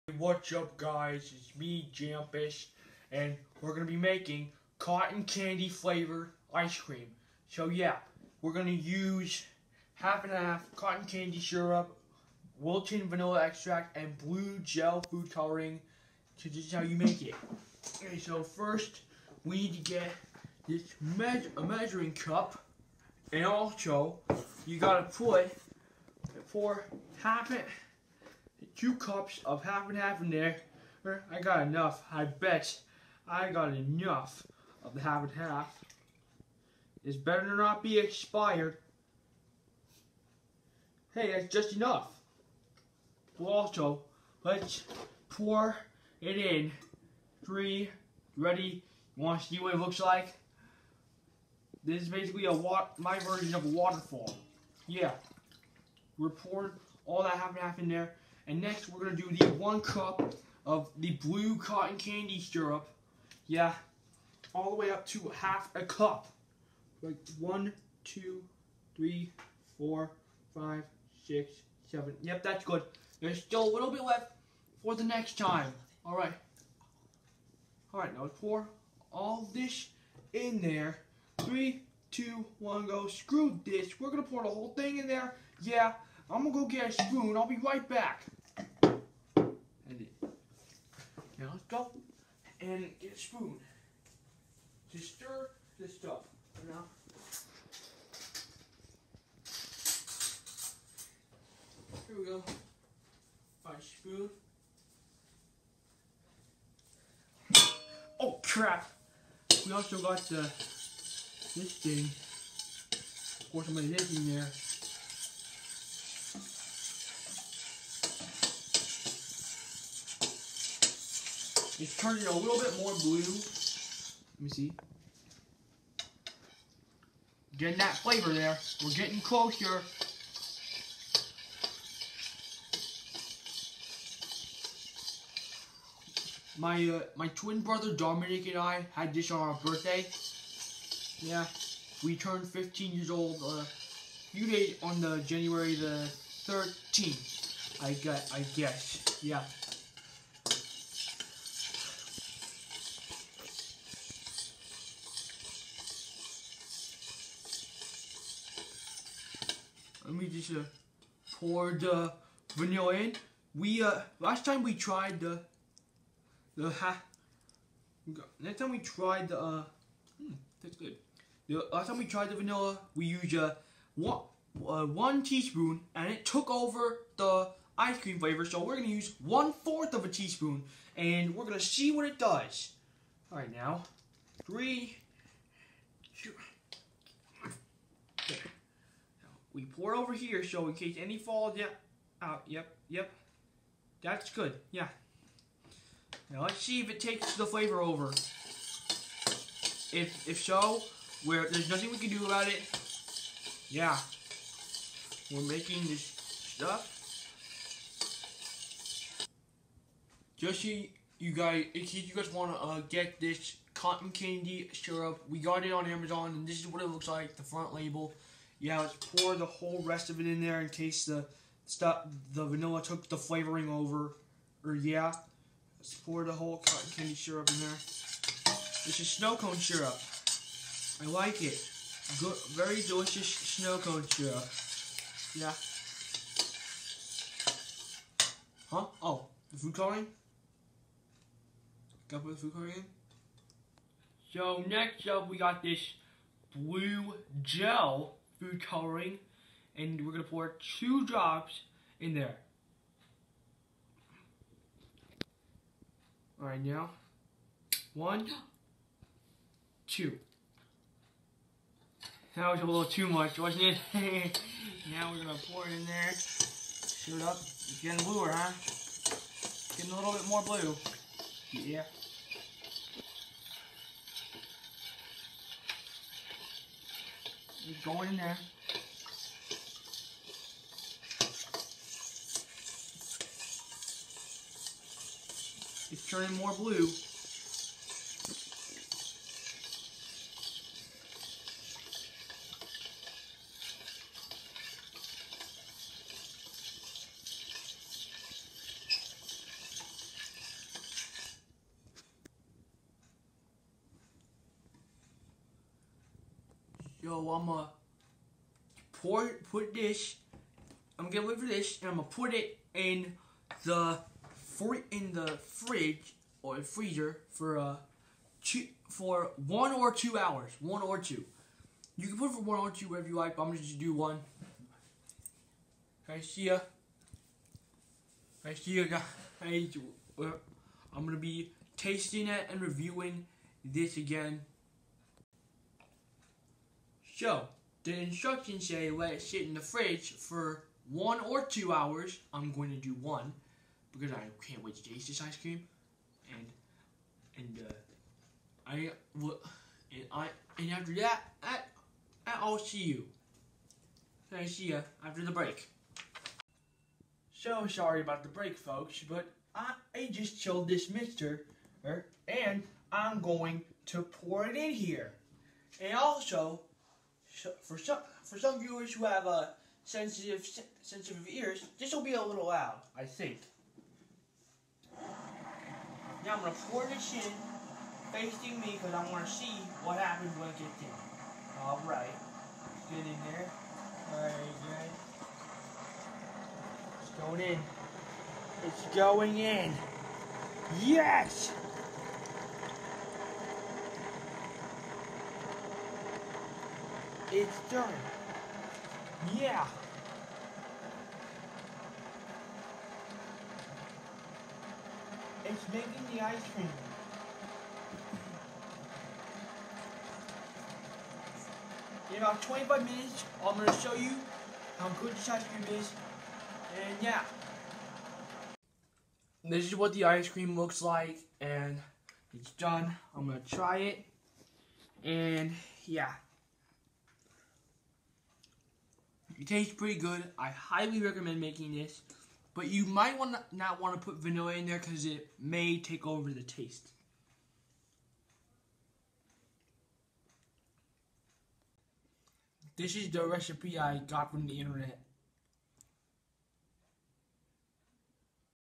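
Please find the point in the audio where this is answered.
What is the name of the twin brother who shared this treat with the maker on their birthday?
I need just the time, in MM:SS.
02:17.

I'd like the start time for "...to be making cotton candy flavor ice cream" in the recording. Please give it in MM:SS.
00:03.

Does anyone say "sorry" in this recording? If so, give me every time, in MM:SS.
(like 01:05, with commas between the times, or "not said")
05:57.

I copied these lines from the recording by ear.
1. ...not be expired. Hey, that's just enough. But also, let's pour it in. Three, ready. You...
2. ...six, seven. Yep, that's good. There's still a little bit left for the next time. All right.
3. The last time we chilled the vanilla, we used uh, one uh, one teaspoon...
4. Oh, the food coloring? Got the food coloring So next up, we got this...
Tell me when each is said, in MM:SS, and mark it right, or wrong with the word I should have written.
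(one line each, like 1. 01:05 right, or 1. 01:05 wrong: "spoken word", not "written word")
1. 00:37 right
2. 01:11 right
3. 02:51 wrong: "tried", not "chilled"
4. 03:59 right.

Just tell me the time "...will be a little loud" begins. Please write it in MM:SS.
06:11.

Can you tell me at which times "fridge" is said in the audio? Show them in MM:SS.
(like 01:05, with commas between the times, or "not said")
05:15, 05:39.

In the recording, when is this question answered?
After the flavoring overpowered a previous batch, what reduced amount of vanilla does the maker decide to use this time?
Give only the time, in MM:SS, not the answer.
02:59.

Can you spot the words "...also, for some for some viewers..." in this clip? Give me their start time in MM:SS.
06:05.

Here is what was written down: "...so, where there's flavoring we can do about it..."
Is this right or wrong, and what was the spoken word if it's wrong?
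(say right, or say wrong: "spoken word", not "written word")
wrong: "nothing", not "flavoring".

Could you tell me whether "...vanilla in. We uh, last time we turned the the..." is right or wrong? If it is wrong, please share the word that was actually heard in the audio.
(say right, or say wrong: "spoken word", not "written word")
wrong: "tried", not "turned".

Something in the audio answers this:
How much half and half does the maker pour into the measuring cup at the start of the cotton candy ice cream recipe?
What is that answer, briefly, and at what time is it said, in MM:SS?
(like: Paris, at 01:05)
2 cups, at 00:28.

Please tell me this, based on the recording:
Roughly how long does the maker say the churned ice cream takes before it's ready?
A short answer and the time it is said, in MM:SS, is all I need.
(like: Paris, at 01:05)
25 minutes, at 06:52.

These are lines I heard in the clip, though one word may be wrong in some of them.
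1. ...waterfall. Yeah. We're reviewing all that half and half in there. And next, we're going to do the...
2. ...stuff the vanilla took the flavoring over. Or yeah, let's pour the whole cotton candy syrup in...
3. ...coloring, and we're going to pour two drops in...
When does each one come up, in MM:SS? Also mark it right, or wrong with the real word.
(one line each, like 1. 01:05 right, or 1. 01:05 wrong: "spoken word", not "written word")
1. 00:53 wrong: "pouring", not "reviewing"
2. 03:41 right
3. 04:08 right.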